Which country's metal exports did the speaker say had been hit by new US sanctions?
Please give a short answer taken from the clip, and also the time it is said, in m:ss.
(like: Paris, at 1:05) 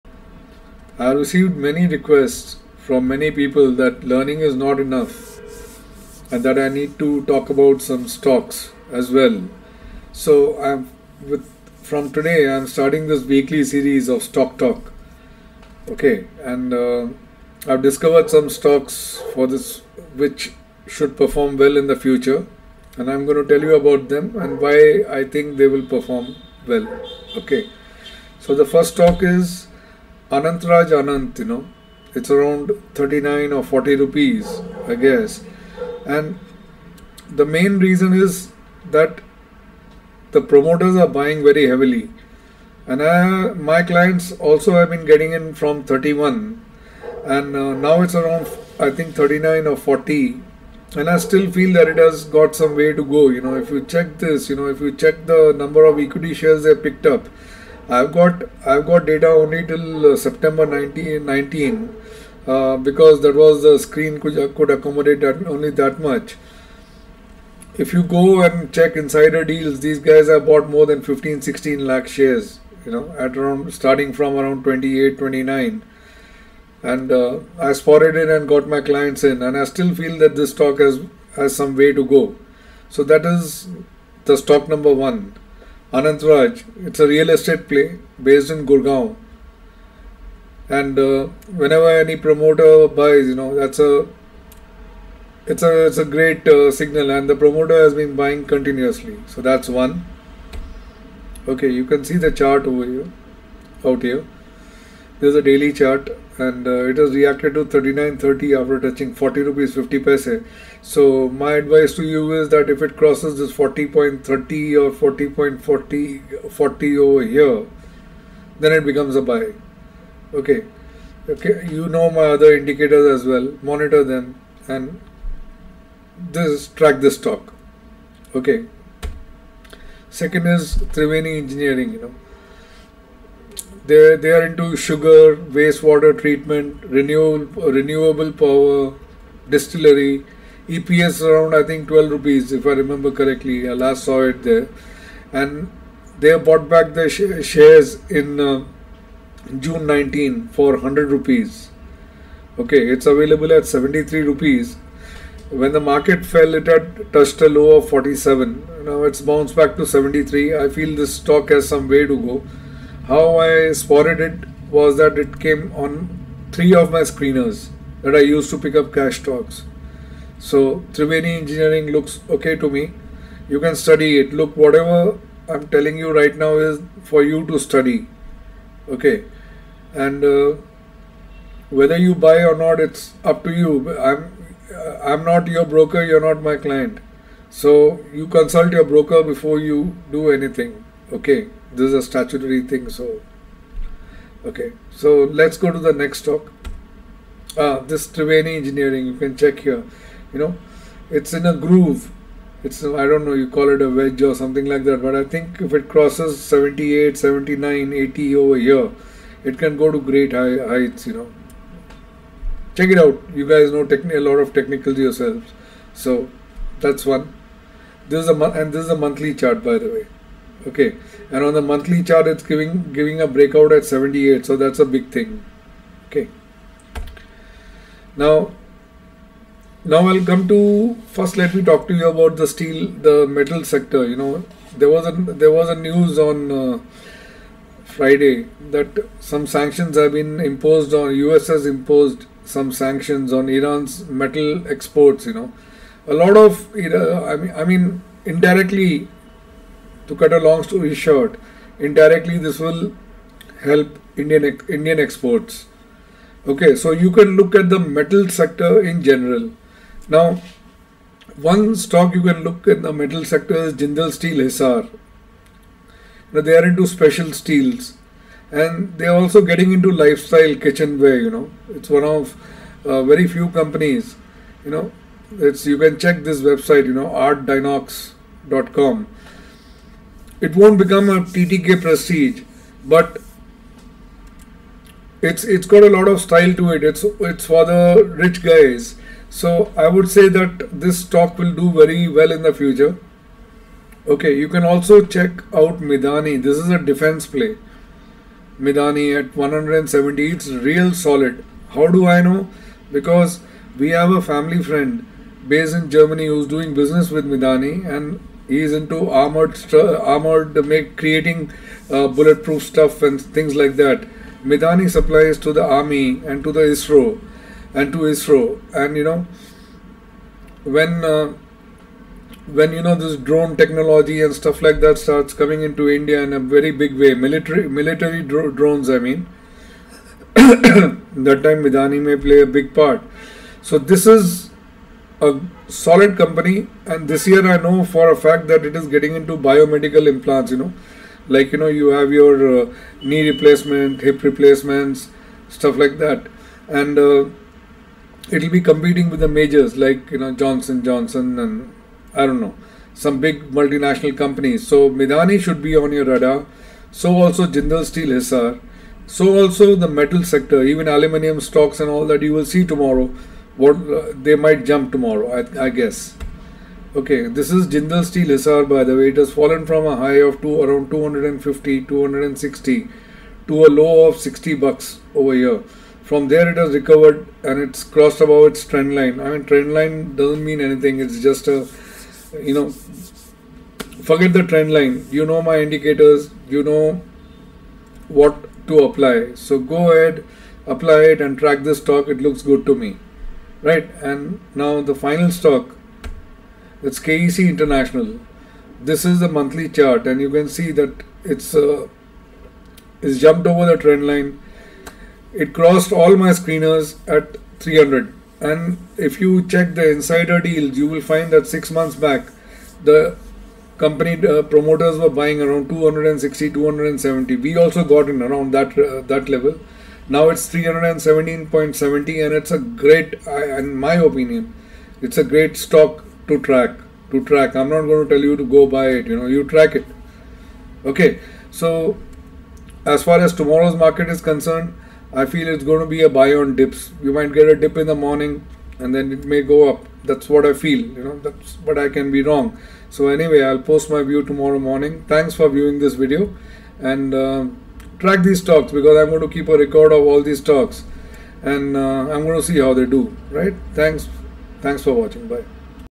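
Iran, at 4:03.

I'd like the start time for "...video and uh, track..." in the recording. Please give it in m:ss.
7:25.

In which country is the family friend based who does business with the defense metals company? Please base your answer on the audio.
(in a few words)
Germany.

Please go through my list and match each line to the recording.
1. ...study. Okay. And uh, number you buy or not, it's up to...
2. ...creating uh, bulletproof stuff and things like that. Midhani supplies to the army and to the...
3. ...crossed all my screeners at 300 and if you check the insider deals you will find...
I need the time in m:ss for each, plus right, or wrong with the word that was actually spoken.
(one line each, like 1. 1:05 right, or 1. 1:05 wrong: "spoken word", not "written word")
1. 2:57 wrong: "whether", not "number"
2. 5:10 right
3. 6:45 right.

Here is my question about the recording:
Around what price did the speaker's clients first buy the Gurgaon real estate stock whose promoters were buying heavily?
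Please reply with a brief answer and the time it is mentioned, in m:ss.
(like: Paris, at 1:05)
31, at 0:45.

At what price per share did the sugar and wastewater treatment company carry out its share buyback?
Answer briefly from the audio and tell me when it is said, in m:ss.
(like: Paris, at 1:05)
100 rupees, at 2:30.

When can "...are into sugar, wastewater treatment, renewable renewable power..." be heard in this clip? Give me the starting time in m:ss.
2:14.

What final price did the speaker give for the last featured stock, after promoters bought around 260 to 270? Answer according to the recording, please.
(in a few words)
317.70.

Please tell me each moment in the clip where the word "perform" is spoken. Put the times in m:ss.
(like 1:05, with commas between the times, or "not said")
0:21, 0:25.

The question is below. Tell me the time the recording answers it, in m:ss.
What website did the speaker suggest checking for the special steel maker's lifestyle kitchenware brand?
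4:37.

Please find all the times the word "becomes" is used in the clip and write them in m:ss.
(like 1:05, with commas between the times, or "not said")
1:58, 4:40.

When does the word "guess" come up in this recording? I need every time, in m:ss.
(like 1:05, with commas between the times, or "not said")
0:34, 6:05.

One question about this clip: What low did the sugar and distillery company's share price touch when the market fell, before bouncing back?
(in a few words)
47.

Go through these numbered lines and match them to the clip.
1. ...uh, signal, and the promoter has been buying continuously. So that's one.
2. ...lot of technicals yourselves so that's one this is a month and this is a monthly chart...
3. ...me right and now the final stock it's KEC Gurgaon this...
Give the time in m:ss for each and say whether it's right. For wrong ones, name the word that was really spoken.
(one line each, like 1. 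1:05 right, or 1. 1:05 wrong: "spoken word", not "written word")
1. 1:36 right
2. 3:34 right
3. 6:32 wrong: "International", not "Gurgaon".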